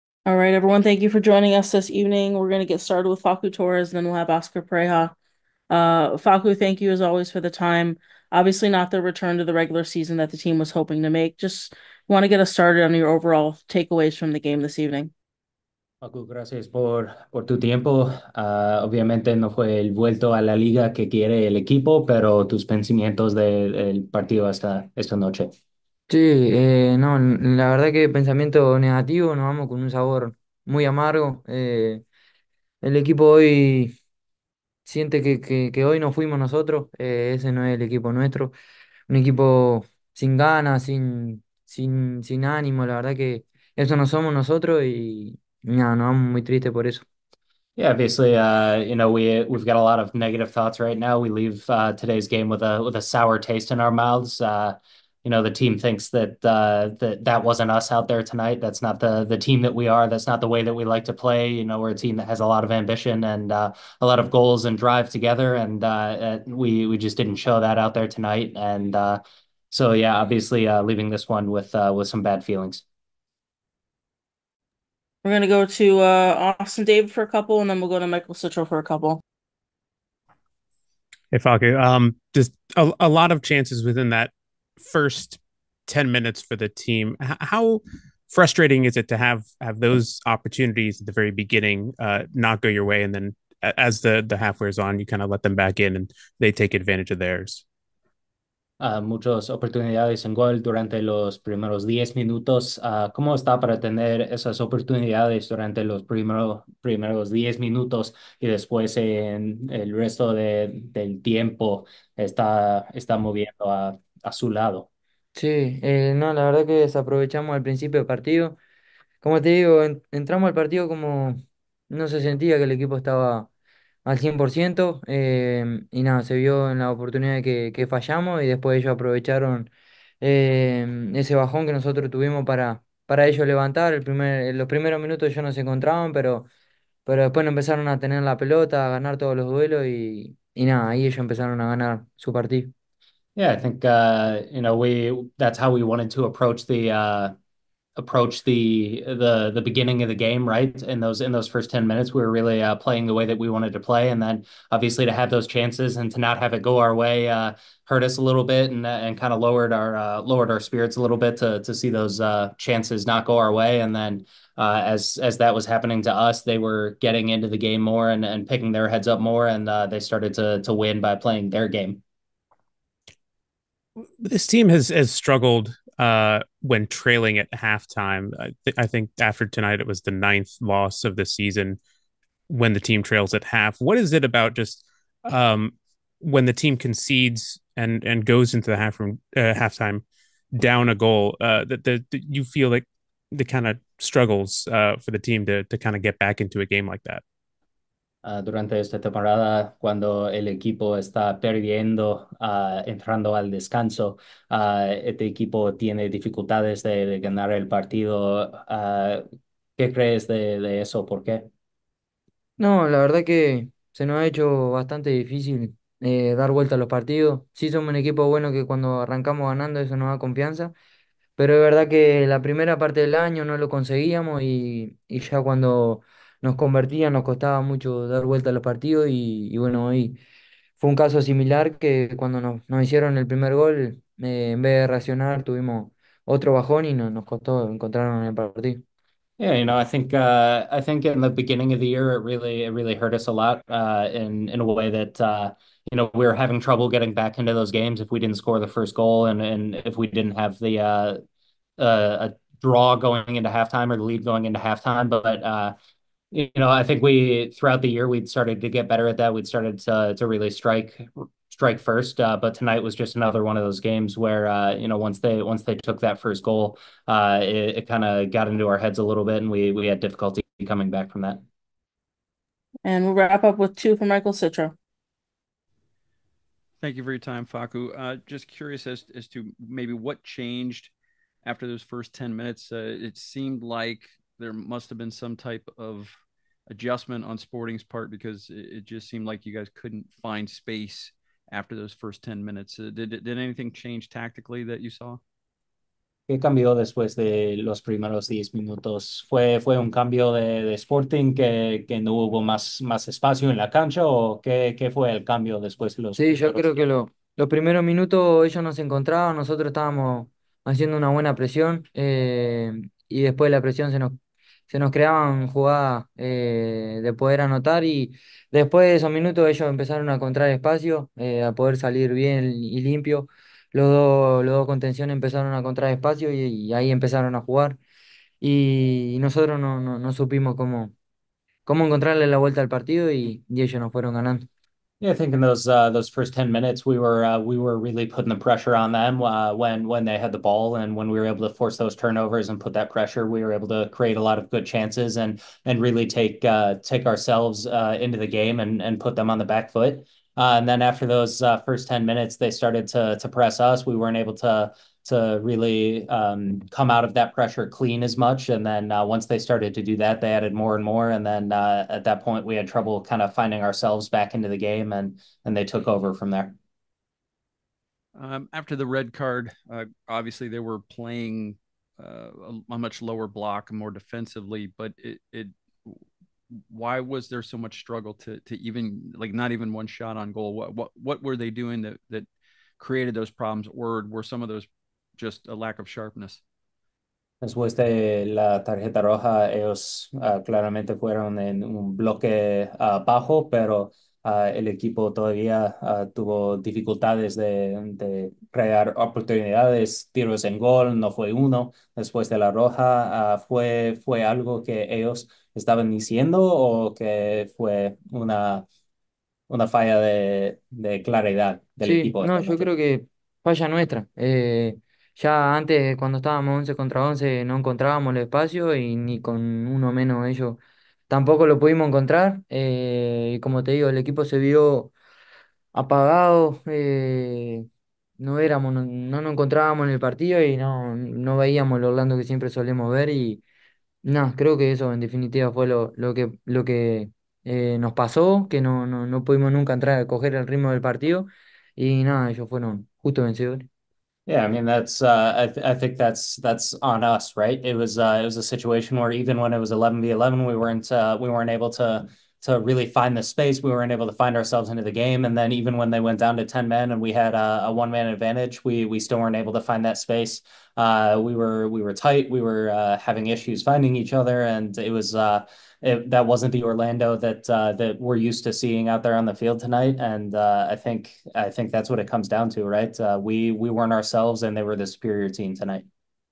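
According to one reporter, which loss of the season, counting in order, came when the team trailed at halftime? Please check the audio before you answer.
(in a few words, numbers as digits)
9th.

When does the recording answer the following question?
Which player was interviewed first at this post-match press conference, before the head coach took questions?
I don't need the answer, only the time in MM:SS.
00:03.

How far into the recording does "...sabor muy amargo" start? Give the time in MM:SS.
00:29.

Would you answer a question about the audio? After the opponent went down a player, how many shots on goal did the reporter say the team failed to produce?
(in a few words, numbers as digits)
1.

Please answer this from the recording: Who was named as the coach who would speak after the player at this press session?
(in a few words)
Oscar Pareja.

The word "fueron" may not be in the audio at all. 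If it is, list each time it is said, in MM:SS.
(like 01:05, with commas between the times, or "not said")
05:33, 06:30, 07:22.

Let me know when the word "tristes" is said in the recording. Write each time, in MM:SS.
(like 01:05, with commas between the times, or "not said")
00:46.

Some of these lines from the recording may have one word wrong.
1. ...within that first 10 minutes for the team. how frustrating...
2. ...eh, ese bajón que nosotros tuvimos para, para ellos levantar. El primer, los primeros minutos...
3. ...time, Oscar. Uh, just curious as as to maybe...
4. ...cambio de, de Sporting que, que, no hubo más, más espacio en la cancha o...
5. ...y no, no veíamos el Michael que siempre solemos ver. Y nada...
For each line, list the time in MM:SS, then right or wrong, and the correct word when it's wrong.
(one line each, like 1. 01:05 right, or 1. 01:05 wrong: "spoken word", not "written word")
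1. 01:23 right
2. 02:10 right
3. 04:37 wrong: "Facu", not "Oscar"
4. 04:59 right
5. 07:10 wrong: "Orlando", not "Michael".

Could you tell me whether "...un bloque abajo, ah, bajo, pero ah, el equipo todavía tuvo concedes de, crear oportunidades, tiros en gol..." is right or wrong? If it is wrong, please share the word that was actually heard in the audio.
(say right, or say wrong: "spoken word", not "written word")
wrong: "dificultades", not "concedes".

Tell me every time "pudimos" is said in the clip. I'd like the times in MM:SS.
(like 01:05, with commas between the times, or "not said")
07:01, 07:19.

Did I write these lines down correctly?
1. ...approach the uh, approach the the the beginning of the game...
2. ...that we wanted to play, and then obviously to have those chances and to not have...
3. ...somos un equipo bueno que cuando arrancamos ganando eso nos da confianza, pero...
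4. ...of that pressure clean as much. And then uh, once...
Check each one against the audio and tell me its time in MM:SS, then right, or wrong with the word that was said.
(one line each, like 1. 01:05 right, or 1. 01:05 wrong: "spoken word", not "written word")
1. 02:26 right
2. 02:33 right
3. 03:37 right
4. 05:57 right.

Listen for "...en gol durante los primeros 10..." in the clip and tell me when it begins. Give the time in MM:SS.
01:40.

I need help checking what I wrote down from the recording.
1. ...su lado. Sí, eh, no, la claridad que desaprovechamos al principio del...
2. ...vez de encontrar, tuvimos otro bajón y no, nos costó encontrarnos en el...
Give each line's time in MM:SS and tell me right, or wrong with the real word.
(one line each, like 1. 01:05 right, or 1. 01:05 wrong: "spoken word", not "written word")
1. 01:54 wrong: "verdad", not "claridad"
2. 03:54 wrong: "reaccionar", not "encontrar".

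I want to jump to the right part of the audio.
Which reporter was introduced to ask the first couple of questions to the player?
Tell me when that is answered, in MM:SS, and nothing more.
01:16.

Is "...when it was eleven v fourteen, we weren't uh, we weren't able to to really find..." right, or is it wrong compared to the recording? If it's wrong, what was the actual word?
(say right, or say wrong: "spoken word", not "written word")
wrong: "eleven", not "fourteen".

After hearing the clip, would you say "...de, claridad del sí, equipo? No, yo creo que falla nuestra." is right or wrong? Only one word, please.
right.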